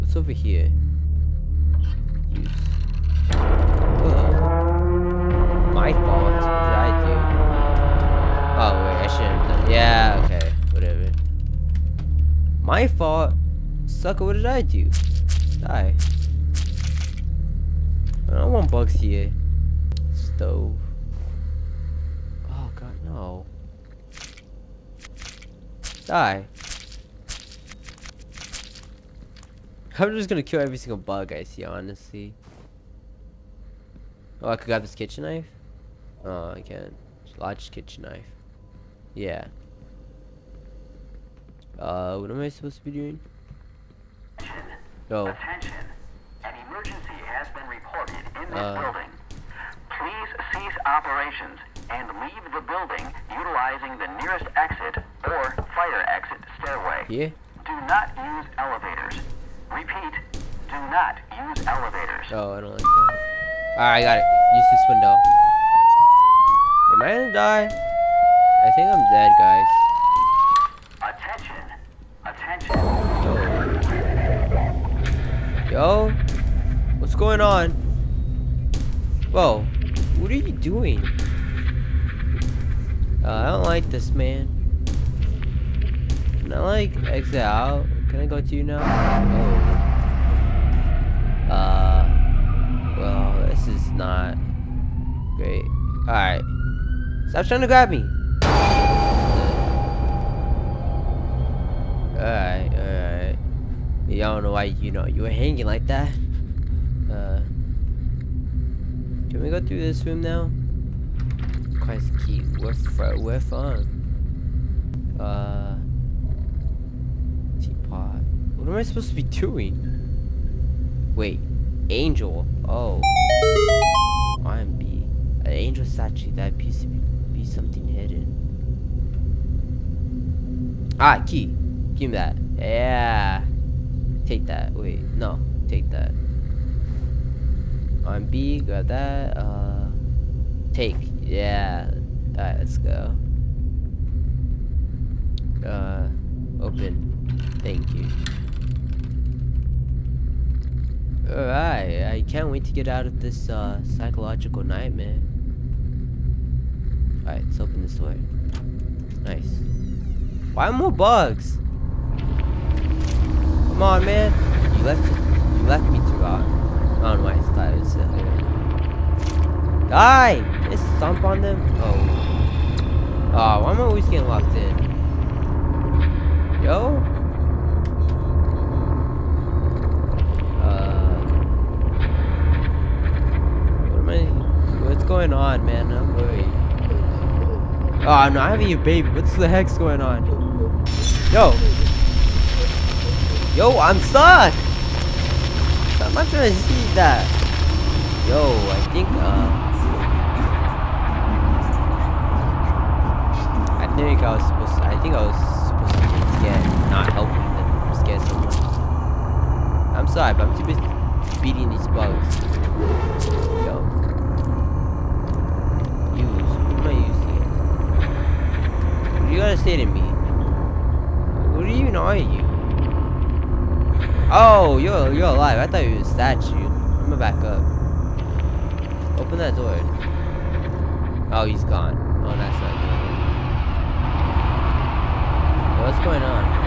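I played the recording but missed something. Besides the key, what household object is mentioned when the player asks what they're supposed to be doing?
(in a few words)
Teapot.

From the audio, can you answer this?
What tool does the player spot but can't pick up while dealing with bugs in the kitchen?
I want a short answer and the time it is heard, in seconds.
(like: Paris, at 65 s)
Large kitchen knife, at 37 s.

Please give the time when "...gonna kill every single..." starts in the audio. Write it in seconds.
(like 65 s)
30 s.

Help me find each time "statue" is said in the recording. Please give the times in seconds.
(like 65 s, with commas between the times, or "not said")
125 s, 226 s.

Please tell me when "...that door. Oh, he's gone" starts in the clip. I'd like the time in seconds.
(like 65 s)
229 s.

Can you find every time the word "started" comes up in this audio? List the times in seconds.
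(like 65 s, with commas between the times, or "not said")
167 s.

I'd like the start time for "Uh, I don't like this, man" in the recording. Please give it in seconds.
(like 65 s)
83 s.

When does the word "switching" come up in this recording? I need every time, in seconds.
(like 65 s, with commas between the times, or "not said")
not said.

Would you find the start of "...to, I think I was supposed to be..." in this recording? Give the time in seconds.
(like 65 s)
204 s.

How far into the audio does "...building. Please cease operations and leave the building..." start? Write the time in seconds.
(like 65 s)
48 s.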